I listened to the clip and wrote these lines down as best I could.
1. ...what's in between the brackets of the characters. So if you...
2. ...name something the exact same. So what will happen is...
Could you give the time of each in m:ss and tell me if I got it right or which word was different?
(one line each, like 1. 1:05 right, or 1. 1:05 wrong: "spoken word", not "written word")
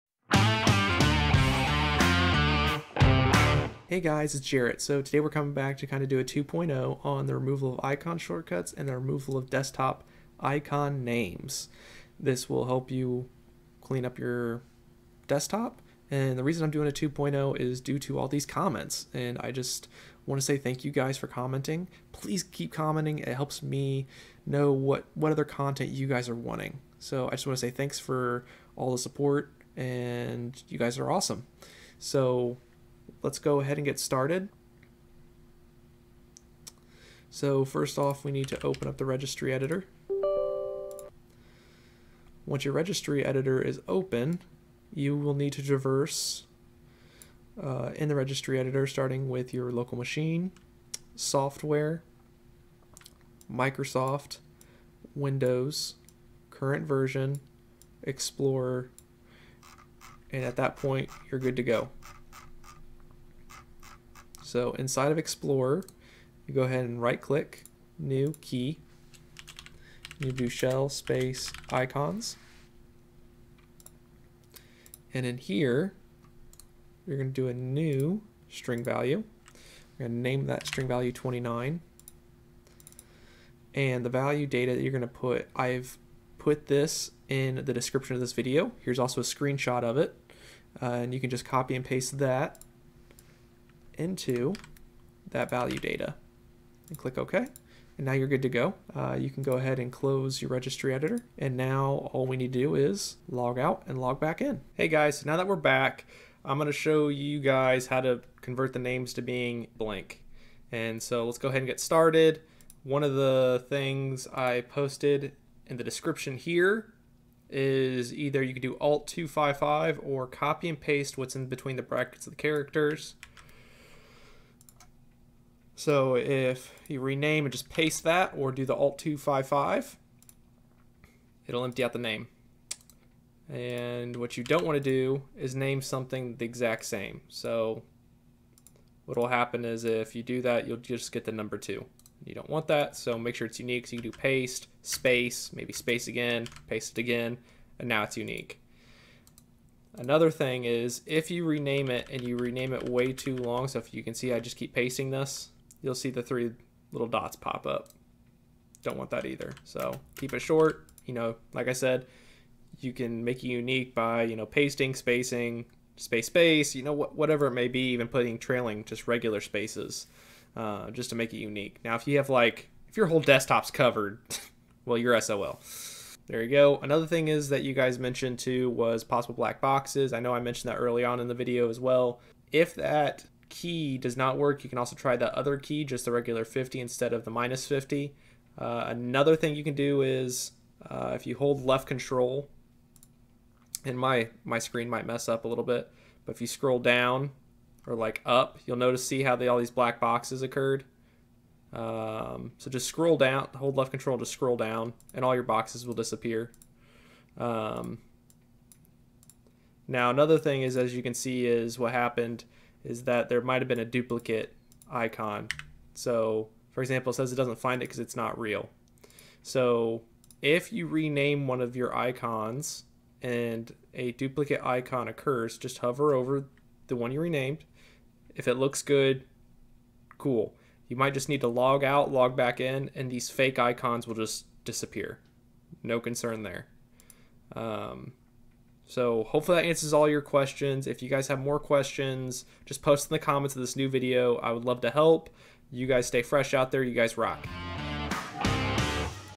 1. 2:01 right
2. 2:15 right.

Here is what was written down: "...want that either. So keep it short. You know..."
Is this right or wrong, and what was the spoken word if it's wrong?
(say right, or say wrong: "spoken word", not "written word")
right.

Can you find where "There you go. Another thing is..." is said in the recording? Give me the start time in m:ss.
2:56.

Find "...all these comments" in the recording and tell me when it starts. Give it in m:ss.
0:18.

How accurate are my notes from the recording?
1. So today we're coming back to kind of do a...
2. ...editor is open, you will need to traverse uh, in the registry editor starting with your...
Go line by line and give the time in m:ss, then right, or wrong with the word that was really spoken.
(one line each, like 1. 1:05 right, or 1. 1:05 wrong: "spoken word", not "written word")
1. 0:04 right
2. 0:43 right.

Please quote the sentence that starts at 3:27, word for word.
Um, now another thing is, as you can see, is what happened is that there might have been a duplicate icon.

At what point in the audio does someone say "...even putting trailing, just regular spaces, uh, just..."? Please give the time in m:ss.
2:47.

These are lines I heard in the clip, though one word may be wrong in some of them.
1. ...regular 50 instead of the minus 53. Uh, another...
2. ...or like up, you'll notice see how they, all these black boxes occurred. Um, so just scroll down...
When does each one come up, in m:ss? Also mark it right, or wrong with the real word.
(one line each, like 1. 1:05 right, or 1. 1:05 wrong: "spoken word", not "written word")
1. 3:06 wrong: "50", not "53"
2. 3:17 right.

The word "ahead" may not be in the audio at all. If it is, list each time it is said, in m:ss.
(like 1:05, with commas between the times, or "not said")
0:33, 1:06, 1:39, 1:51.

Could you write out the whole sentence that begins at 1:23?
And the value data that you're going to put, I've put this in the description of this video.